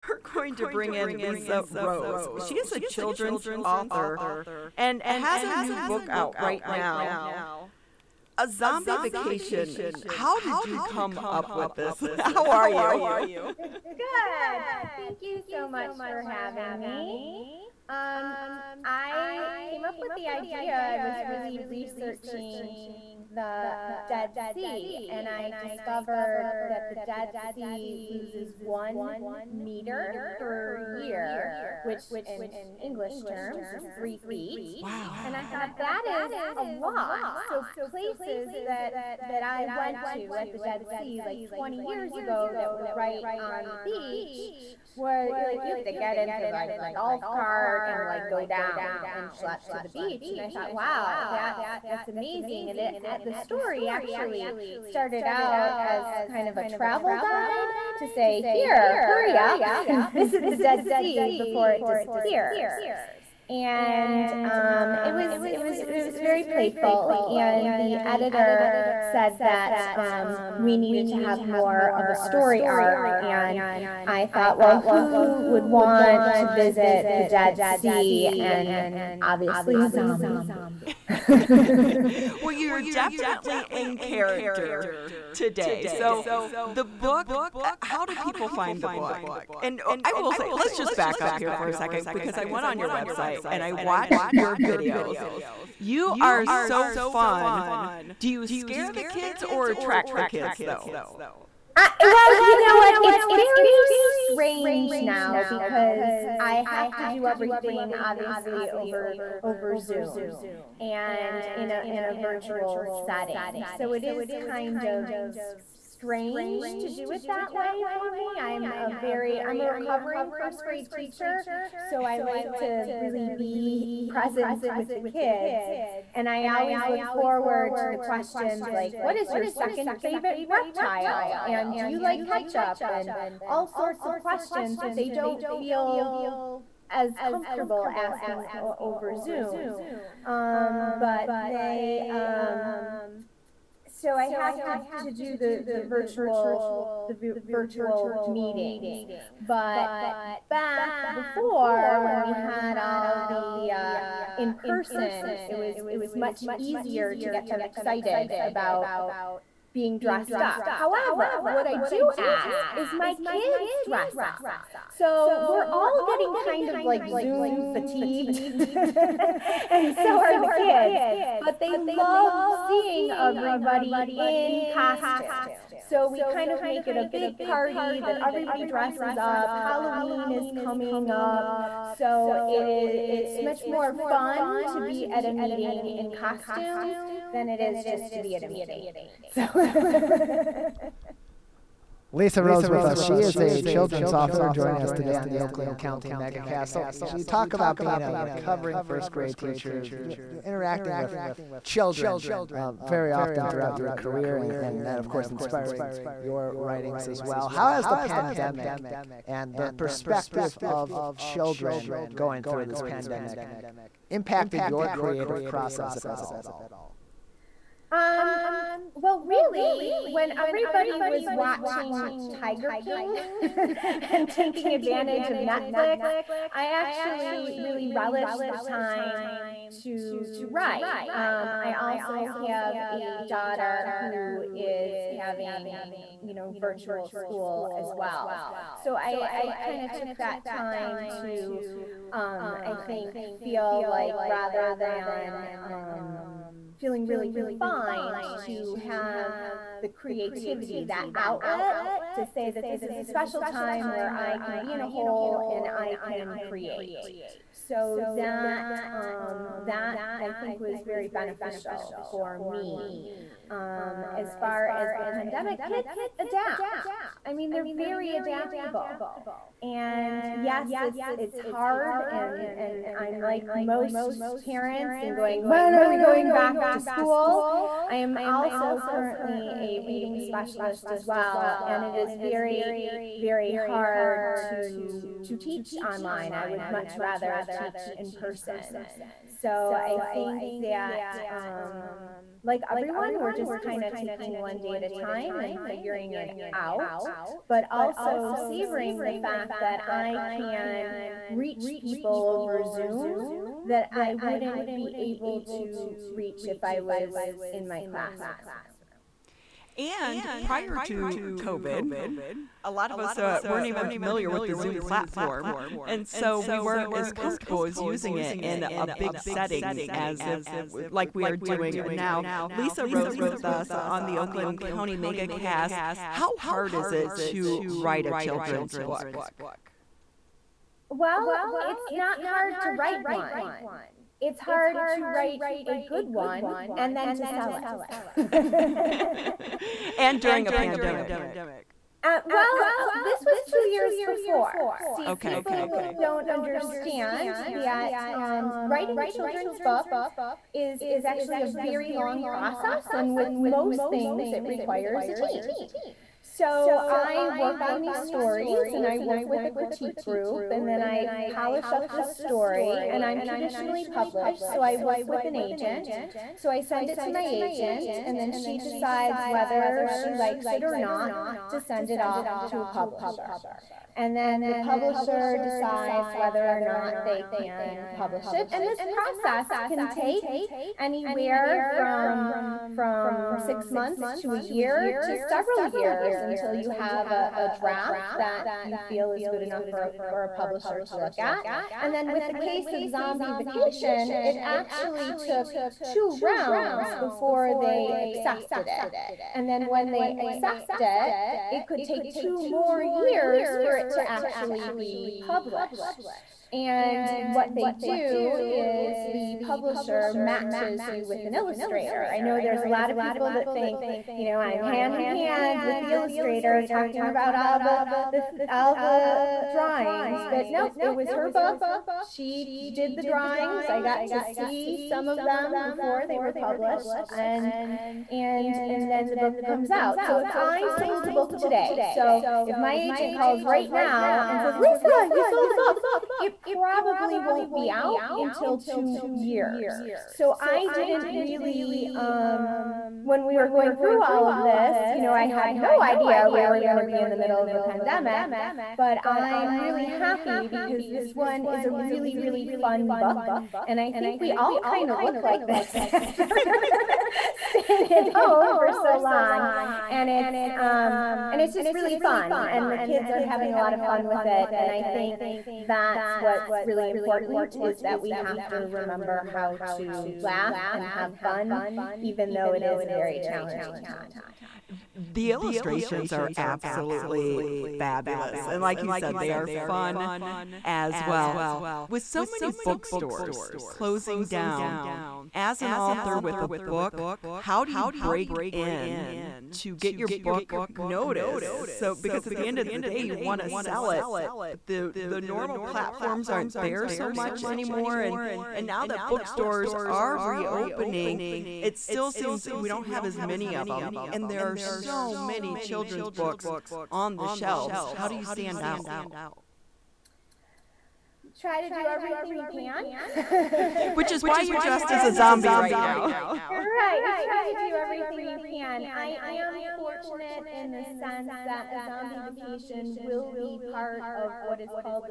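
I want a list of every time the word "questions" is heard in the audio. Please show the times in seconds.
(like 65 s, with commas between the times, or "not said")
127 s, 134 s.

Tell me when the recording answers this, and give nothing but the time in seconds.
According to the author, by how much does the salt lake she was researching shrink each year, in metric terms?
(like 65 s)
28 s.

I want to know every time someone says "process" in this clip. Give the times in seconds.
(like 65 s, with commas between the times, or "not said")
215 s, 352 s, 378 s.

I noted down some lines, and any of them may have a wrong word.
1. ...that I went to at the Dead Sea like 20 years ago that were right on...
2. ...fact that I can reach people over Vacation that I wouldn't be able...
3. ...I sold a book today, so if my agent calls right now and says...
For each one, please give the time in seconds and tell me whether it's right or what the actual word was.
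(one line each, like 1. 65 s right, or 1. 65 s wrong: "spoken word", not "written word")
1. 39 s right
2. 299 s wrong: "Zoom", not "Vacation"
3. 430 s right.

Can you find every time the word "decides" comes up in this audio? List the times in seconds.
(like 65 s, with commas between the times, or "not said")
368 s, 375 s.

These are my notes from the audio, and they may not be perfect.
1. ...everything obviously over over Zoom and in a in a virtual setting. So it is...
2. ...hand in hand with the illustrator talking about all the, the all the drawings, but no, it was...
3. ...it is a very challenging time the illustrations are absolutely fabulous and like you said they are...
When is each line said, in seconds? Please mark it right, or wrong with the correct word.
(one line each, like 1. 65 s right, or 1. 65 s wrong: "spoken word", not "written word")
1. 107 s right
2. 414 s right
3. 472 s right.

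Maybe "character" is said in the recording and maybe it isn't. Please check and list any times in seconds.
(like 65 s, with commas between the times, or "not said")
83 s.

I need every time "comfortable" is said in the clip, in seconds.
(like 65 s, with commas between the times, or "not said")
137 s, 317 s.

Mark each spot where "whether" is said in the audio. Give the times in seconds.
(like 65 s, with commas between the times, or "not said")
369 s, 376 s.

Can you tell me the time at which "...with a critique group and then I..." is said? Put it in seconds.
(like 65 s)
359 s.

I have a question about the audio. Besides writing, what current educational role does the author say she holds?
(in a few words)
reading specialist.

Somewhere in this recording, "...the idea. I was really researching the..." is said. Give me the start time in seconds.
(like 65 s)
20 s.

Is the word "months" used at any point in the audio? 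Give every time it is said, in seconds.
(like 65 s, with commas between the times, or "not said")
383 s.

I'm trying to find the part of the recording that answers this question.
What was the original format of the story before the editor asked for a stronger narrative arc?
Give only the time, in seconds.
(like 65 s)
56 s.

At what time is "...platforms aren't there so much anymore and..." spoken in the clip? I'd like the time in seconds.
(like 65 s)
495 s.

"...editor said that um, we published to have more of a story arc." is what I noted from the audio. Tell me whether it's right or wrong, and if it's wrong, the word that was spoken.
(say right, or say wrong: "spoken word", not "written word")
wrong: "needed", not "published".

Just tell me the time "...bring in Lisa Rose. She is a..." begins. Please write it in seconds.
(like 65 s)
0 s.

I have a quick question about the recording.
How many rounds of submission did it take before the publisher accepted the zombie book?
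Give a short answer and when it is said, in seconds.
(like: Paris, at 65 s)
2 rounds, at 395 s.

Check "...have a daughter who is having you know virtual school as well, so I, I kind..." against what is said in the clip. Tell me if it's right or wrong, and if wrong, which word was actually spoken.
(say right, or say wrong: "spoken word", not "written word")
right.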